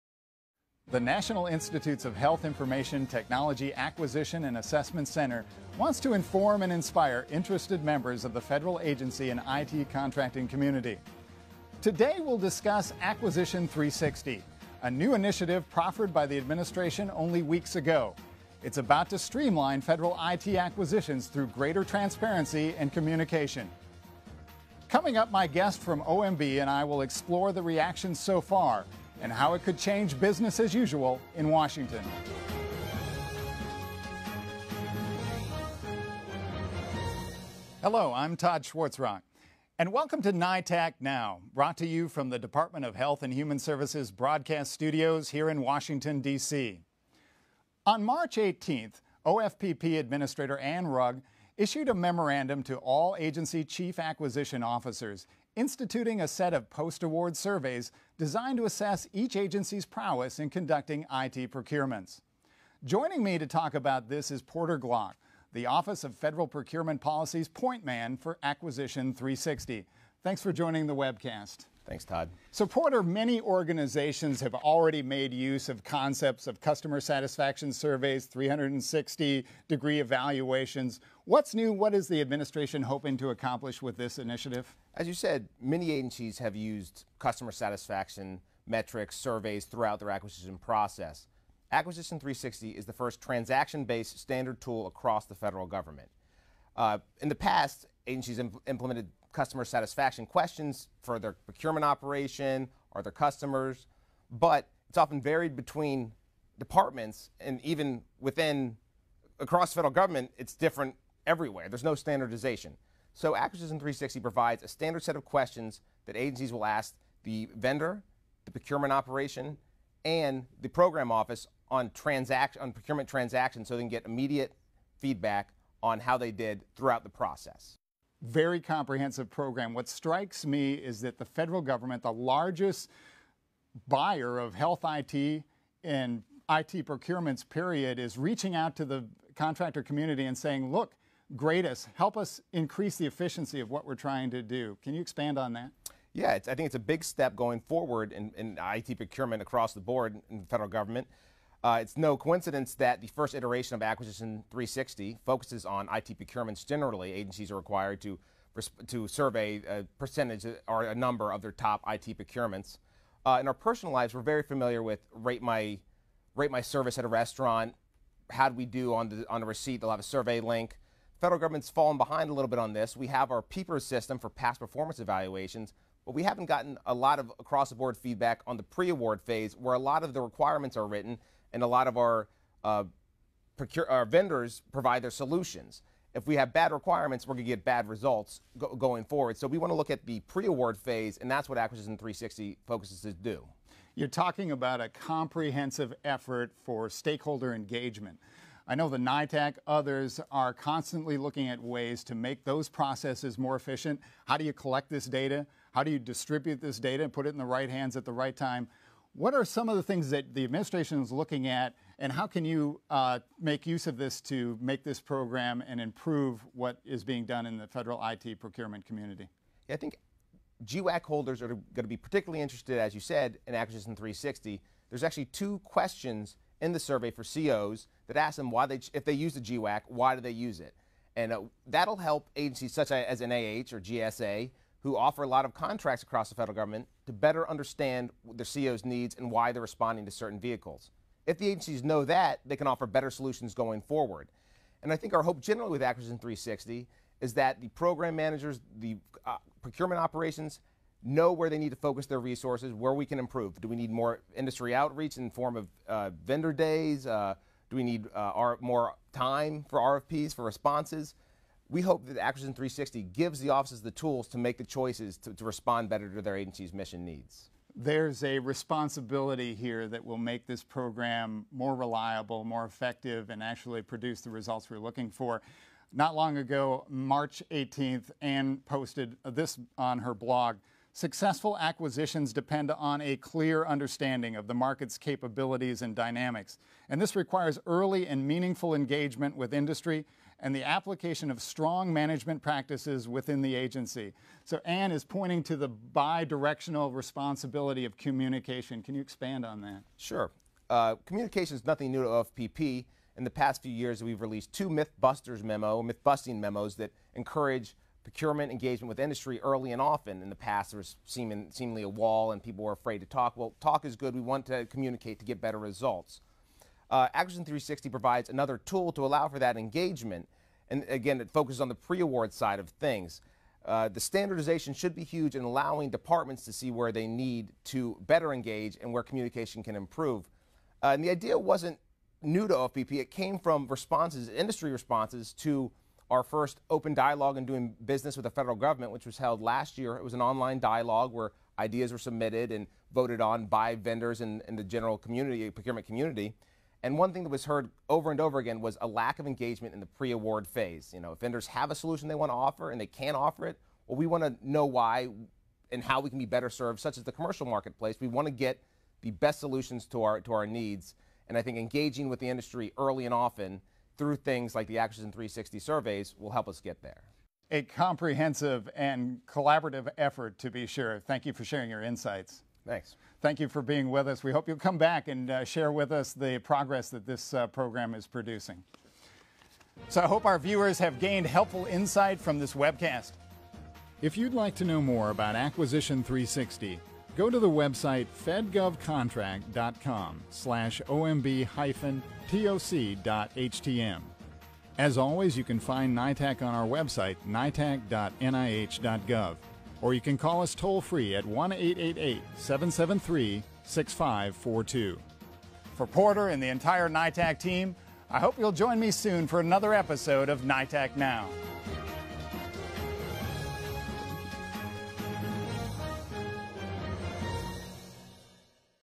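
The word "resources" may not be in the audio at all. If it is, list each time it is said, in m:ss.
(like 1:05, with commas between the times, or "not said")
4:12.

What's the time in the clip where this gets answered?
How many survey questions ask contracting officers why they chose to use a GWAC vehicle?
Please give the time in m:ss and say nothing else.
3:45.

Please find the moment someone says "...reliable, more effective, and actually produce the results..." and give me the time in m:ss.
4:31.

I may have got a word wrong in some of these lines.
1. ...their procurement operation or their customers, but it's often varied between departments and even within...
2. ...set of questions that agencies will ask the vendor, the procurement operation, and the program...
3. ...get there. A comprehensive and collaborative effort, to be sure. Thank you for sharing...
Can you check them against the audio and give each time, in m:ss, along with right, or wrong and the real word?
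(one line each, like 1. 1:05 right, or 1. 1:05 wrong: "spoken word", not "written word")
1. 1:41 right
2. 1:55 right
3. 6:06 right.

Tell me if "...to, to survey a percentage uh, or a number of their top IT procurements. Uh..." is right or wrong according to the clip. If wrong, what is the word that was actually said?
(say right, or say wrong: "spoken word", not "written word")
right.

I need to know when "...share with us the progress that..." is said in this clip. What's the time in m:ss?
6:15.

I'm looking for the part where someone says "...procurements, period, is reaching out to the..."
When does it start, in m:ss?
2:16.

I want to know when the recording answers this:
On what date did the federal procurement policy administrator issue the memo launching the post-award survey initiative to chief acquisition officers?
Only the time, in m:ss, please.
0:47.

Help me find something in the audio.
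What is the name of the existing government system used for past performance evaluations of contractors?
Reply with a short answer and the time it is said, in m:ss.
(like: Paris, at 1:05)
PPIRS, at 2:53.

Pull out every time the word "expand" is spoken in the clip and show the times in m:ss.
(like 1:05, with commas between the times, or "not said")
2:25, 4:59.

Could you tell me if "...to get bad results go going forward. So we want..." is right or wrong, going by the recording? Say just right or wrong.
right.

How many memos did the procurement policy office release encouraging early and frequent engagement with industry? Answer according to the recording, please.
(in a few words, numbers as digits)
2.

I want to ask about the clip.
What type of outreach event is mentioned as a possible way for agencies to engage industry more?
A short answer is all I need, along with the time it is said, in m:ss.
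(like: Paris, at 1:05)
vendor days, at 4:16.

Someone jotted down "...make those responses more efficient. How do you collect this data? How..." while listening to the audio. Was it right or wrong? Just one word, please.
wrong.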